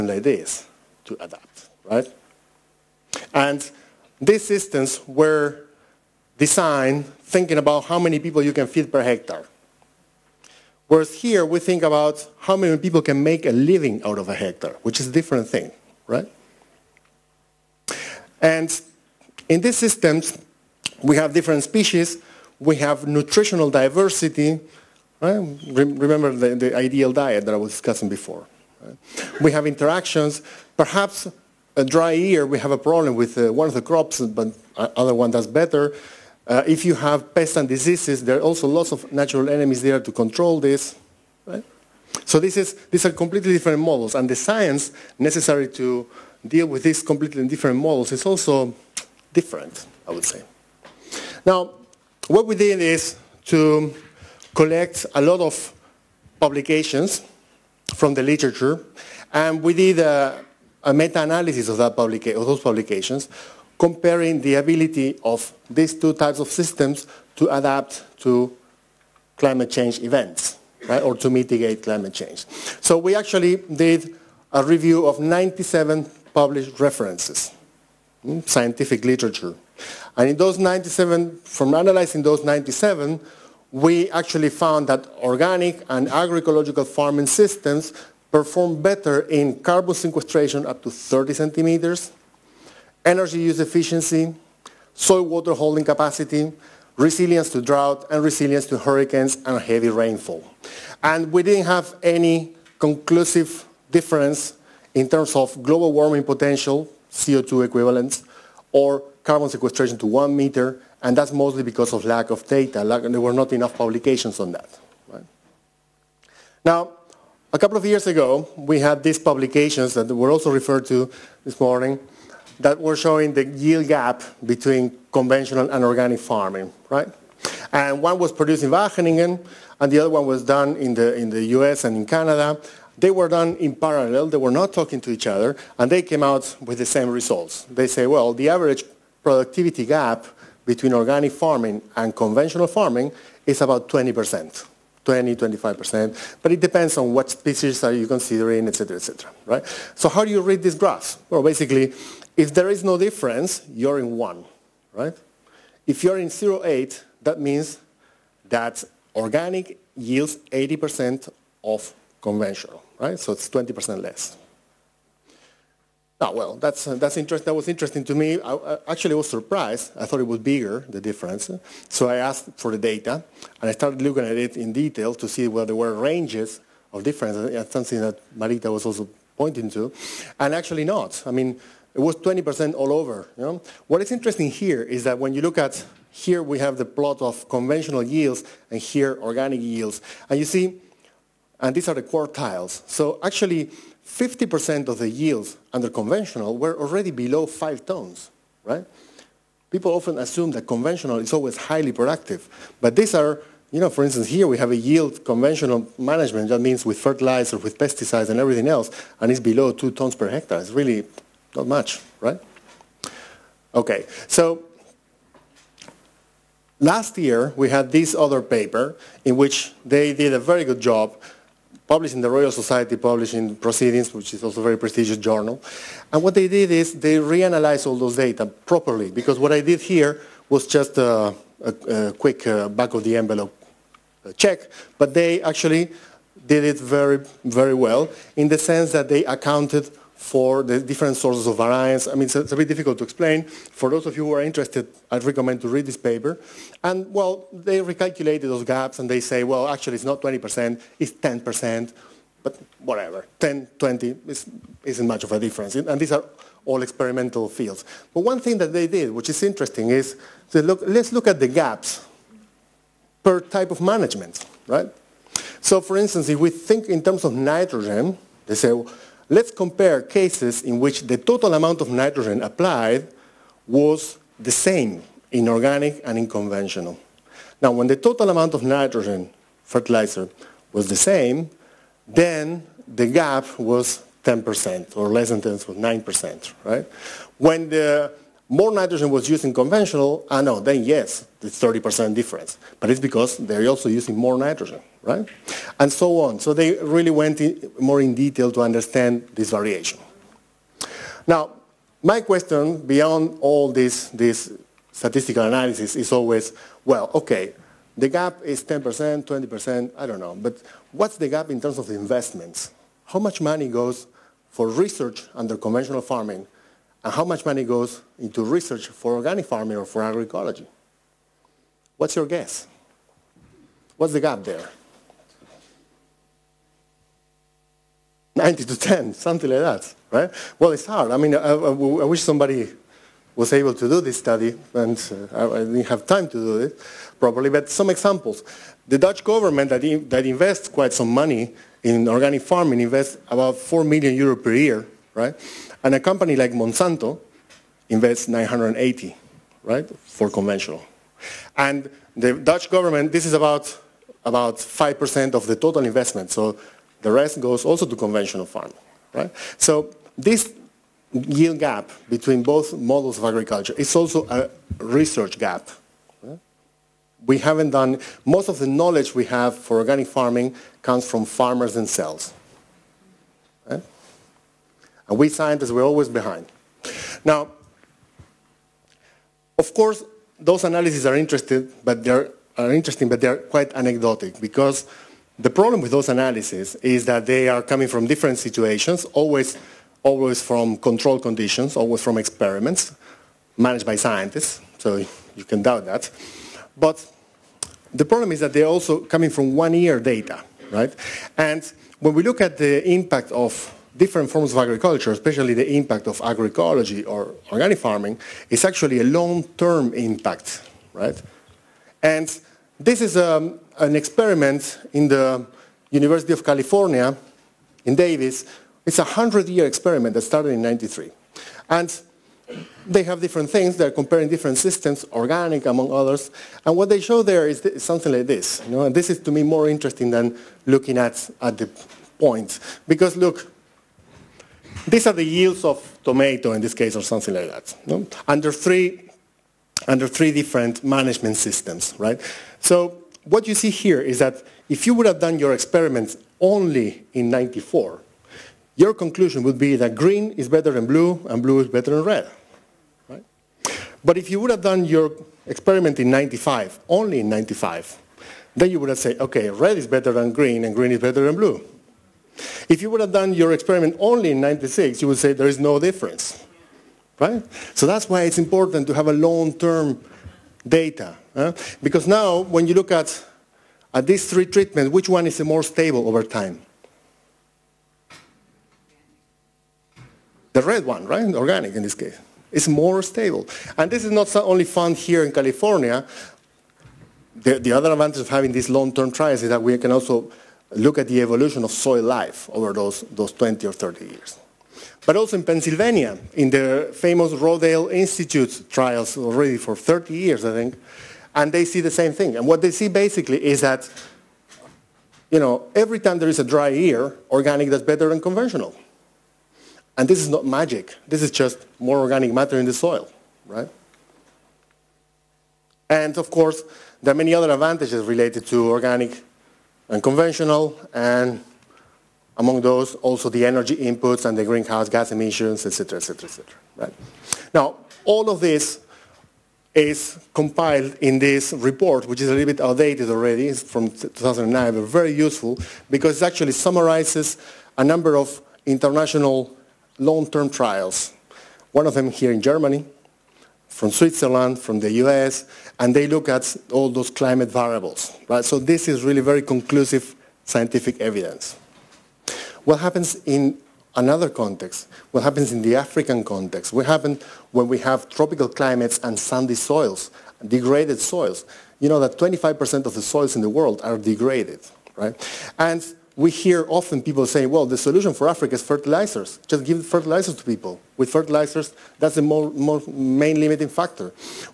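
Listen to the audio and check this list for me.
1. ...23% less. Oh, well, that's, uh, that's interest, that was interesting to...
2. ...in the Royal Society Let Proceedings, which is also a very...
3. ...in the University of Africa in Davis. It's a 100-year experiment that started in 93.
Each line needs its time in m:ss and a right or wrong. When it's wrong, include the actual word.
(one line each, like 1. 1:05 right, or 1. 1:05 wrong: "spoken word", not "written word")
1. 2:43 wrong: "20", not "23"
2. 3:42 wrong: "Publishing", not "Let"
3. 6:54 wrong: "California", not "Africa".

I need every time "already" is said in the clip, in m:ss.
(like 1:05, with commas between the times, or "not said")
3:16, 8:19, 8:53.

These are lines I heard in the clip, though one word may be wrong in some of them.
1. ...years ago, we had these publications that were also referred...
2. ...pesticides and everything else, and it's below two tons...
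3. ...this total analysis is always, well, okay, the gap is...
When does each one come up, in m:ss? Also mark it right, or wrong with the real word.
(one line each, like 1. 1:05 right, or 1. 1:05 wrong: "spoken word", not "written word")
1. 1:57 right
2. 3:27 right
3. 5:04 wrong: "statistical", not "total".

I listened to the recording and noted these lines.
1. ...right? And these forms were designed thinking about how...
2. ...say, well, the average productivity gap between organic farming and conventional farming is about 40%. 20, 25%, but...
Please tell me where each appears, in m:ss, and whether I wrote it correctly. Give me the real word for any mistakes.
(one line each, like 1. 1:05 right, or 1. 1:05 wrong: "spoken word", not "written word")
1. 0:01 wrong: "systems", not "forms"
2. 2:17 wrong: "20", not "40".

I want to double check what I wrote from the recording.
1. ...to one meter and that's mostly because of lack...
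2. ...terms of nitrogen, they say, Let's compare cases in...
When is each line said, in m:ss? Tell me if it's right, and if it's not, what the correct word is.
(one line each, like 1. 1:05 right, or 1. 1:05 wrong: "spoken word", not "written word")
1. 1:49 right
2. 4:27 right.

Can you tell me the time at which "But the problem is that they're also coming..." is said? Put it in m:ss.
6:36.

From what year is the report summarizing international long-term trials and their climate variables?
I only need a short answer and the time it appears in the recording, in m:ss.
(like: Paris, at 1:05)
2009, at 8:53.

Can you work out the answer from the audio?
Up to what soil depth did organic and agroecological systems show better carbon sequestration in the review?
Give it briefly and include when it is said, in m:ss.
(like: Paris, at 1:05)
30 centimeters, at 1:30.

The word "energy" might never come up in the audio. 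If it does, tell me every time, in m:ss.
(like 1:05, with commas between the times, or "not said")
1:33, 8:43.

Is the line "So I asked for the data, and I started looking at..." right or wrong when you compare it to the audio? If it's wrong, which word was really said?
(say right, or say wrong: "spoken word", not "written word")
right.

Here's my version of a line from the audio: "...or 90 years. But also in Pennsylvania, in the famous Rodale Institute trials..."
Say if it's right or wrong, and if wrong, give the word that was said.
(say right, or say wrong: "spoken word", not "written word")
wrong: "30", not "90".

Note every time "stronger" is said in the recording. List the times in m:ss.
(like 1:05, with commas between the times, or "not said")
not said.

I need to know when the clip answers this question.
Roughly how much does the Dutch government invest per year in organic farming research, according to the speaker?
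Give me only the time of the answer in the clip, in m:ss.
5:43.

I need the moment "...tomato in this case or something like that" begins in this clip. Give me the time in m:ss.
7:16.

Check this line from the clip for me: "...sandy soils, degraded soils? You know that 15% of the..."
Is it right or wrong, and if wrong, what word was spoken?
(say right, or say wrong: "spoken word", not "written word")
wrong: "25", not "15".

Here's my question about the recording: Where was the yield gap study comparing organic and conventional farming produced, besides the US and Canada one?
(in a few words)
Wageningen.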